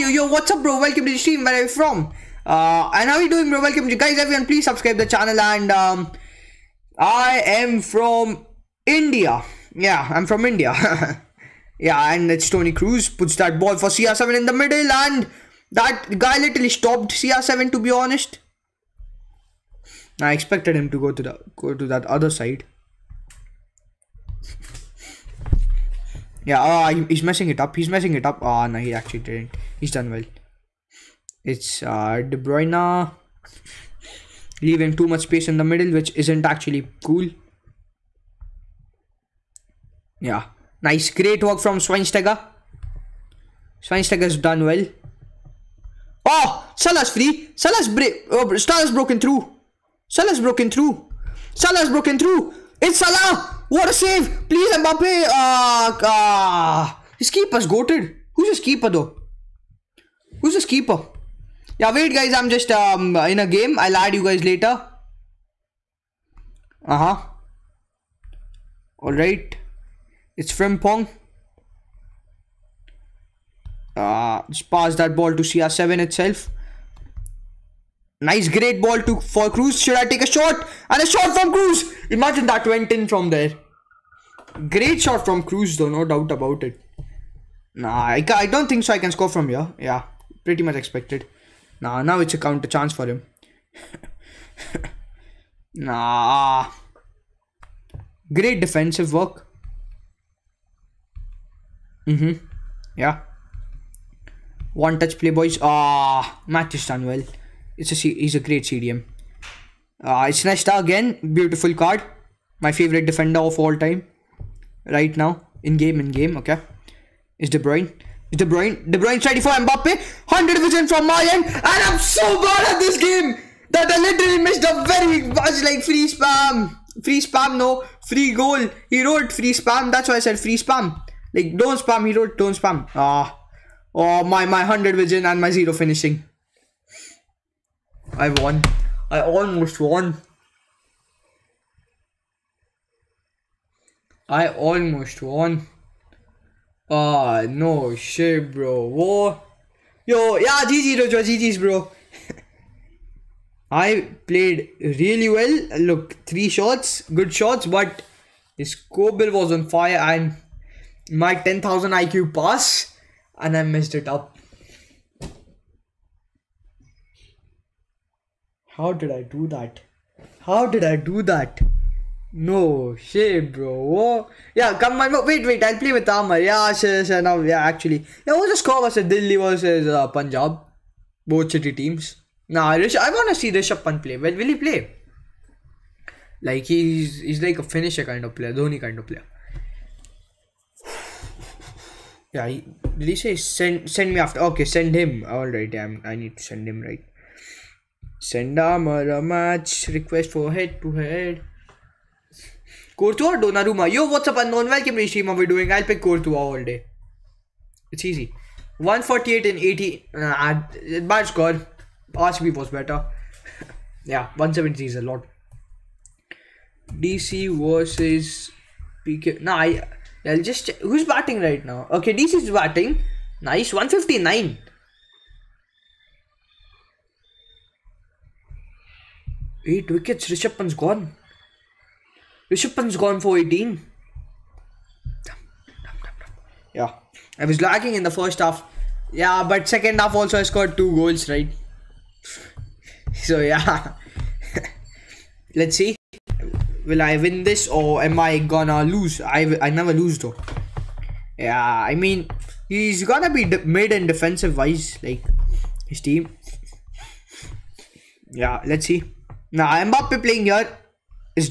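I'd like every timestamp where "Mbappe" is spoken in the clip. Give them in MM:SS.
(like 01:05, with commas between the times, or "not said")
00:54, 01:59, 04:19.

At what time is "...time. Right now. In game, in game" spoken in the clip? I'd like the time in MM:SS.
01:53.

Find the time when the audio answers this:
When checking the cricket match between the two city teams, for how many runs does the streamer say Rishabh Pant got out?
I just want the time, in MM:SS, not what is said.
03:53.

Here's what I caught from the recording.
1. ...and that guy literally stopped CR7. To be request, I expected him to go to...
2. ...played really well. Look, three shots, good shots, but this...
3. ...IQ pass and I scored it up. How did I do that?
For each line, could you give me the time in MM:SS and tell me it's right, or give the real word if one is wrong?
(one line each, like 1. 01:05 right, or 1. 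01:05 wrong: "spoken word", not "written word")
1. 00:14 wrong: "honest", not "request"
2. 02:34 right
3. 02:41 wrong: "messed", not "scored".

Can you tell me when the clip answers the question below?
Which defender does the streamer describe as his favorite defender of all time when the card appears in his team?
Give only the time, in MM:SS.
01:50.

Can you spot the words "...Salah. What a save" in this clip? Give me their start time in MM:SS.
00:52.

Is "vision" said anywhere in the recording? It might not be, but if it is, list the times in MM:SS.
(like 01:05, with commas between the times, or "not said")
02:00, 02:14.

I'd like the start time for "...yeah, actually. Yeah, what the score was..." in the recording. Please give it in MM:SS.
02:57.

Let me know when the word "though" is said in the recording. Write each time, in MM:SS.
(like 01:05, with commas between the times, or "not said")
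00:58, 01:25, 04:10.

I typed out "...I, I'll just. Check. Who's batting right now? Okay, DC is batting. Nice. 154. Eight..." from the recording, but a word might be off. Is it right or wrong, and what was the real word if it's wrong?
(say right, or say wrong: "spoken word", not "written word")
wrong: "159", not "154".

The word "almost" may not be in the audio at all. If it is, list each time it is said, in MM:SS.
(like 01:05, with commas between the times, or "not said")
02:19, 02:24.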